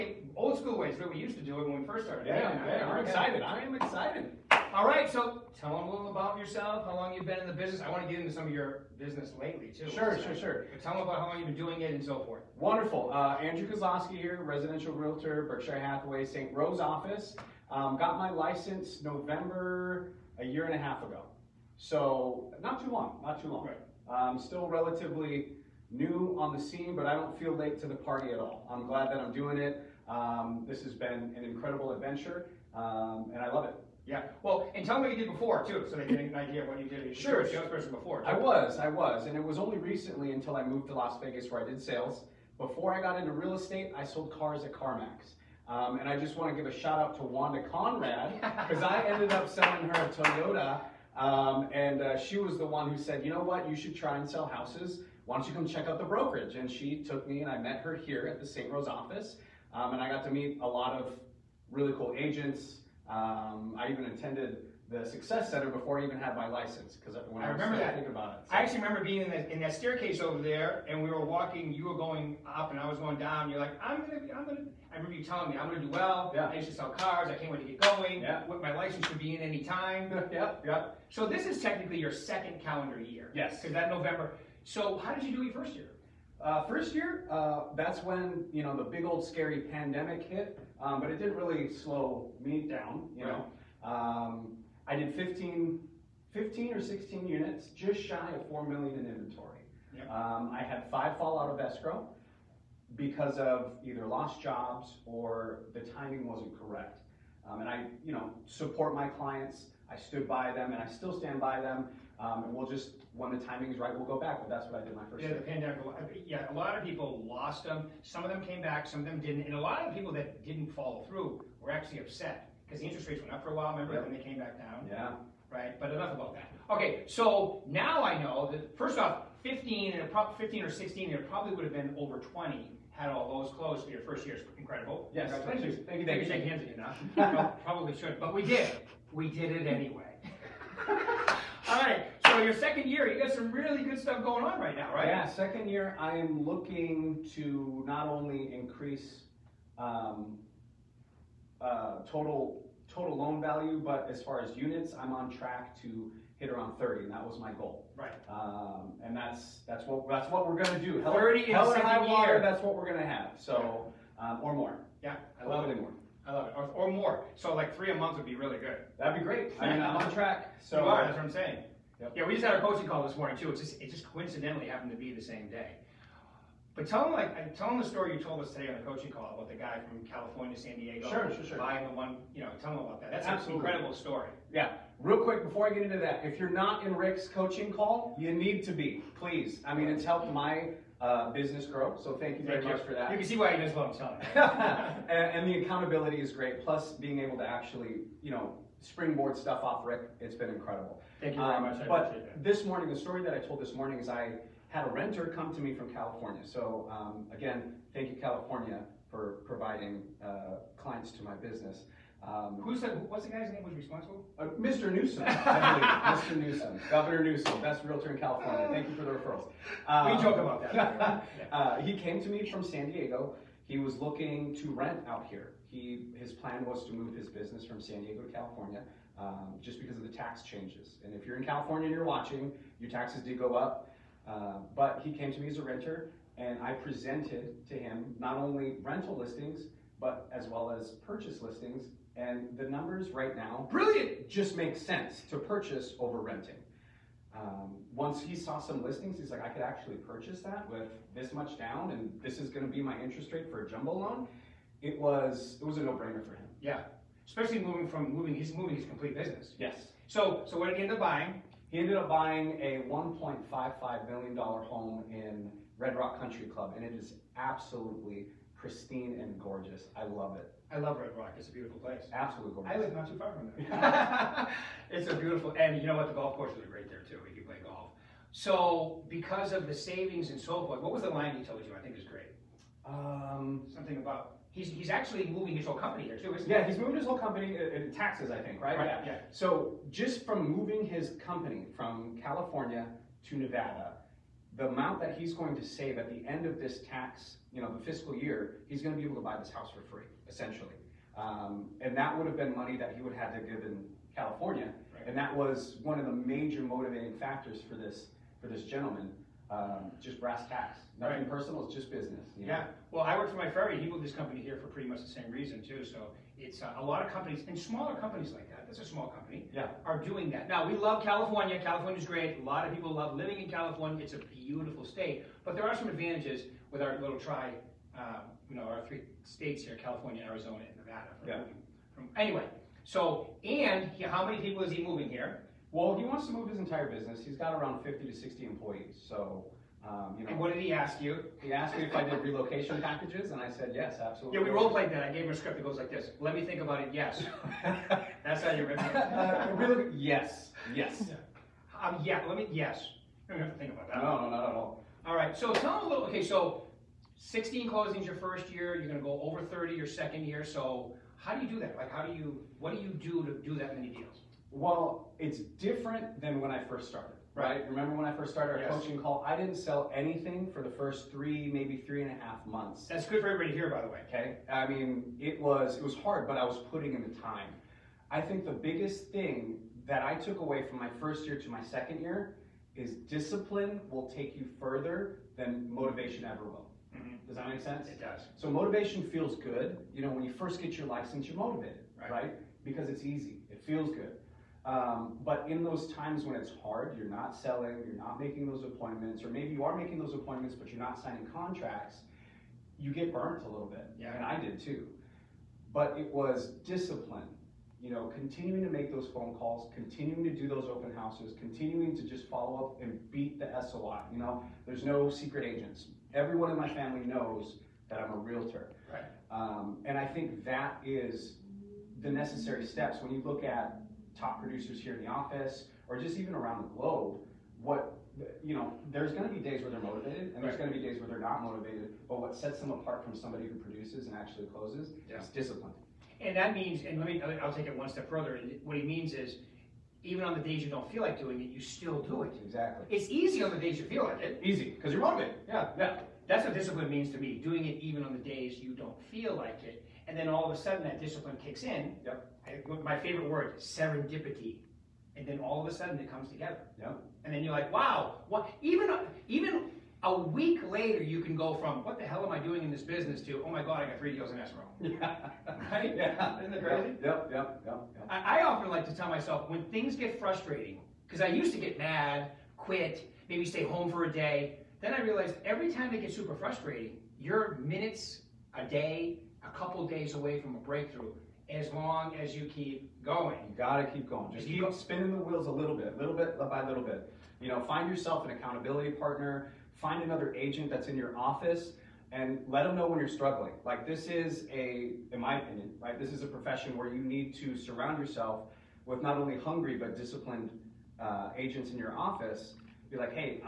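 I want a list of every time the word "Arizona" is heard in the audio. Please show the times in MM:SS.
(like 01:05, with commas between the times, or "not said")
05:30.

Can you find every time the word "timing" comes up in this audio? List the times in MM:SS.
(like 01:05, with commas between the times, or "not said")
01:45, 01:53.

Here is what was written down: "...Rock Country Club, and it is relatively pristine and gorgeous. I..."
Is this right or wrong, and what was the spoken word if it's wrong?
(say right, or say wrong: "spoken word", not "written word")
wrong: "absolutely", not "relatively".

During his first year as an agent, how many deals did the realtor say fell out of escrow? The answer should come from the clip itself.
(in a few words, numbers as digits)
5.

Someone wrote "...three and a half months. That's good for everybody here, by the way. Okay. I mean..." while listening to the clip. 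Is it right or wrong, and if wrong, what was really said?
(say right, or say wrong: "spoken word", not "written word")
right.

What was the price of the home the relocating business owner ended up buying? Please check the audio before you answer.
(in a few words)
1.55 million dollars.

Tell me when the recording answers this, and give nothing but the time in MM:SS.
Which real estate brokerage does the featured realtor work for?
00:15.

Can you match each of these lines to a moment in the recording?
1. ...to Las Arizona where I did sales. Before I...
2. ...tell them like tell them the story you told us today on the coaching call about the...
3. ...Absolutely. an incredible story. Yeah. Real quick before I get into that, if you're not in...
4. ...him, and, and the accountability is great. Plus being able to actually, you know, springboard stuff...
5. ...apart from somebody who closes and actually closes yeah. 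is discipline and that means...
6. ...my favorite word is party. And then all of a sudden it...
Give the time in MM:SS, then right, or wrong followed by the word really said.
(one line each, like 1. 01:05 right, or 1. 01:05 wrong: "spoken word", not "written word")
1. 00:40 wrong: "Vegas", not "Arizona"
2. 02:56 right
3. 03:03 right
4. 03:13 right
5. 07:12 wrong: "produces", not "closes"
6. 07:32 wrong: "serendipity", not "party".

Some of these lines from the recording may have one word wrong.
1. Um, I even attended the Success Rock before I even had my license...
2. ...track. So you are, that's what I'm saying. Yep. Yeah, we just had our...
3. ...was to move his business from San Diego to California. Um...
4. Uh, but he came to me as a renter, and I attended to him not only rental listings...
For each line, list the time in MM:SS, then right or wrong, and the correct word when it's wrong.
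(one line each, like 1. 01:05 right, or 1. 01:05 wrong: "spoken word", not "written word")
1. 01:03 wrong: "Center", not "Rock"
2. 02:50 right
3. 03:46 right
4. 03:54 wrong: "presented", not "attended".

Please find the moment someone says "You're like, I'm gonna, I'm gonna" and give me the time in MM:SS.
01:13.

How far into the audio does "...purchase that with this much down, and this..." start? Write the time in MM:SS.
04:09.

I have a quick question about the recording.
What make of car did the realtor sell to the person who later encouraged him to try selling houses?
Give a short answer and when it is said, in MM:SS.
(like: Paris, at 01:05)
Toyota, at 00:50.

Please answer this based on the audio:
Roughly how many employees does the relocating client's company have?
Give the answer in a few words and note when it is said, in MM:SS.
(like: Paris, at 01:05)
50 to 60, at 05:37.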